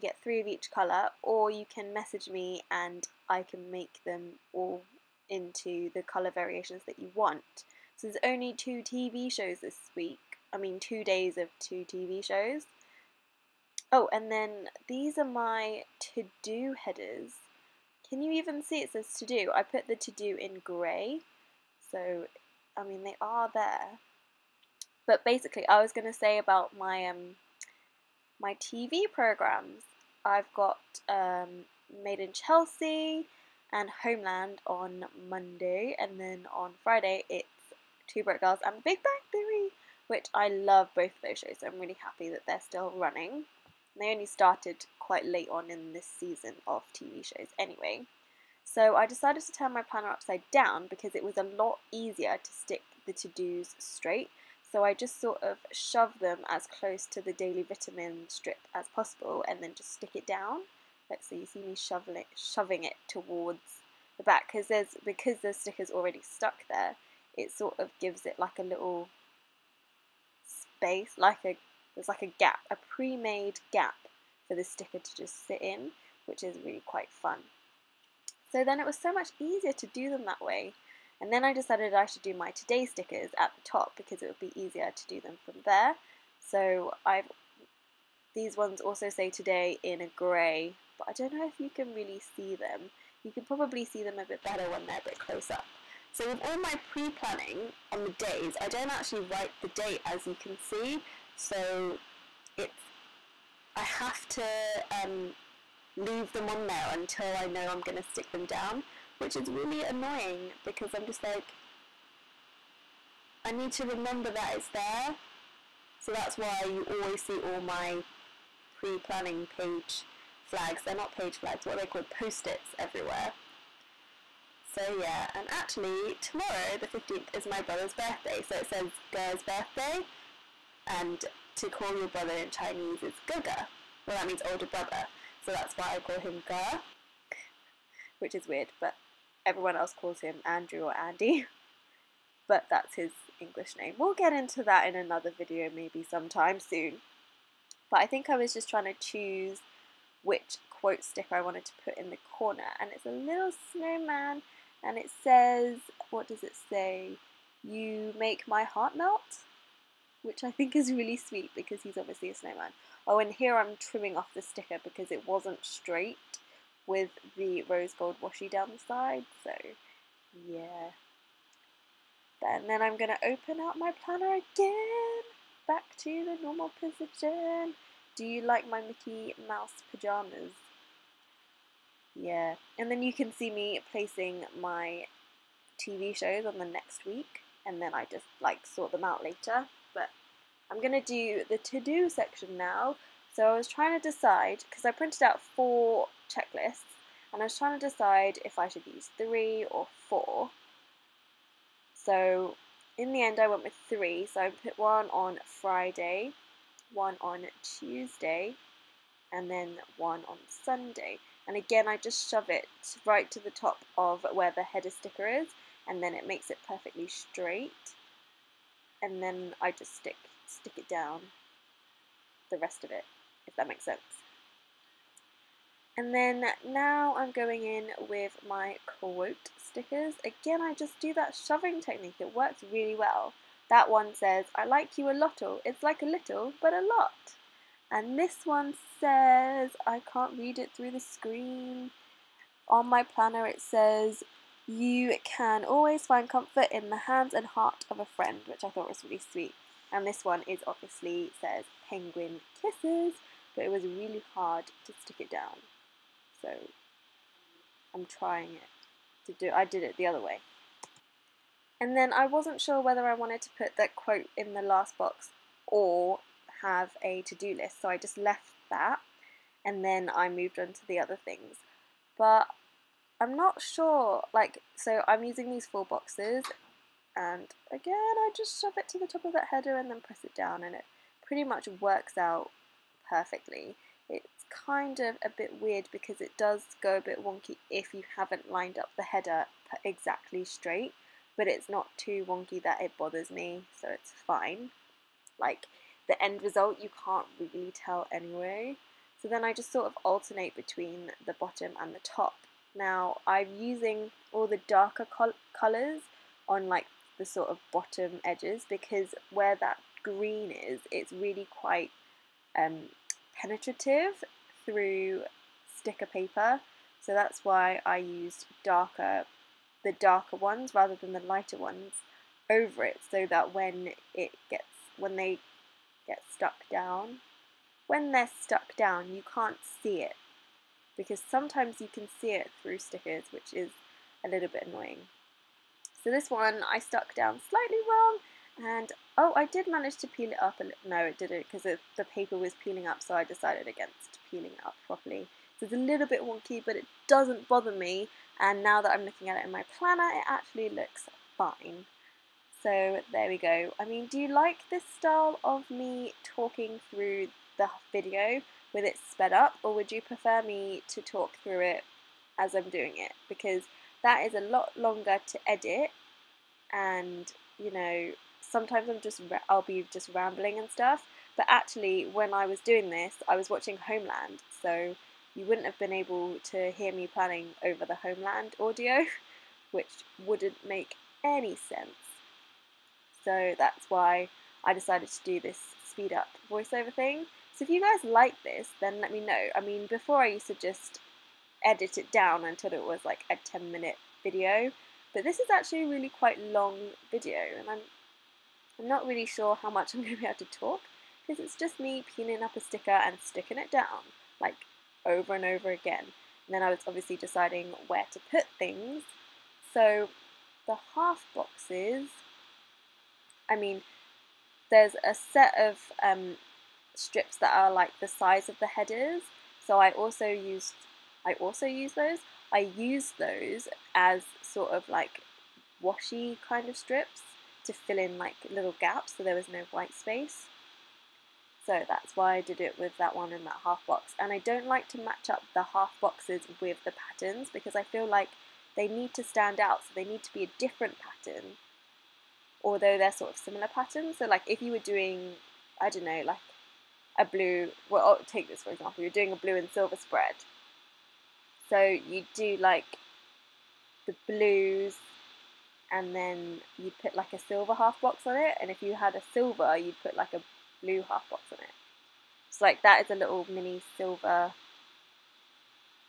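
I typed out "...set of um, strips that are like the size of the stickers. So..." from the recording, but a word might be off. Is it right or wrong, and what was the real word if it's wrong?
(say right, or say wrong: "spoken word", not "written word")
wrong: "headers", not "stickers".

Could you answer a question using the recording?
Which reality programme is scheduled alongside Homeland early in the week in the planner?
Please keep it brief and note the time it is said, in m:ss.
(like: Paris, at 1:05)
Made in Chelsea, at 0:32.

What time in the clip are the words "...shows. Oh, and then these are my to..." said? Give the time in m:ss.
0:12.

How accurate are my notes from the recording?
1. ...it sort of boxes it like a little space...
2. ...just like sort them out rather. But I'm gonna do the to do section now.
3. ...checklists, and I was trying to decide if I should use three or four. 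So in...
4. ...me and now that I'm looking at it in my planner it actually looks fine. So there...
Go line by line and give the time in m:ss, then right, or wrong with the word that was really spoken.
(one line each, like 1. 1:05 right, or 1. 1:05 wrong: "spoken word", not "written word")
1. 1:07 wrong: "gives", not "boxes"
2. 3:08 wrong: "later", not "rather"
3. 3:16 right
4. 5:47 right.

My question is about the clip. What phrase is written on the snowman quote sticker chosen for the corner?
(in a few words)
You make my heart melt.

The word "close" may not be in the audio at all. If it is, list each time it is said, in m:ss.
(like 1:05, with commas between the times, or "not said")
0:56, 1:35.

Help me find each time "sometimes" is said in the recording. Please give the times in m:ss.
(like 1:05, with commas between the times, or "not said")
2:26, 5:31, 6:08.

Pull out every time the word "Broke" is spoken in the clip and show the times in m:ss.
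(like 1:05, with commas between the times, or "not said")
0:38.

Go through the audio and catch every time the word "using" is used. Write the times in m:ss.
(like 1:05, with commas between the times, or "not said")
4:35, 5:03.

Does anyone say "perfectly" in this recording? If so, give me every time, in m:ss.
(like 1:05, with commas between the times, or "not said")
3:36, 4:43.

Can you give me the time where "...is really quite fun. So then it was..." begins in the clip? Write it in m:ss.
1:16.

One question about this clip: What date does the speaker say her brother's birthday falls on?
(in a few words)
15th.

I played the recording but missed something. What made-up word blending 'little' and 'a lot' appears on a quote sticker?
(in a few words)
lottle.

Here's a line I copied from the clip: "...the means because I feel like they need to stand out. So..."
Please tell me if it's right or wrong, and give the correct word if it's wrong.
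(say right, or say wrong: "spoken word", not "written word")
wrong: "patterns", not "means".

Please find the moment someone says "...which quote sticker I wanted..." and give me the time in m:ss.
2:30.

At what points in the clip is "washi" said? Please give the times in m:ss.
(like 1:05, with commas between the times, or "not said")
2:48, 7:05.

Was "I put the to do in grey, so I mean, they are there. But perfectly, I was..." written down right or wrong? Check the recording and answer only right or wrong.
wrong.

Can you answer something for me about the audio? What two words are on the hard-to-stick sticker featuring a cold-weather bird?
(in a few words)
penguin kisses.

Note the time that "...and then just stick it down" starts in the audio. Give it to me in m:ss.
0:59.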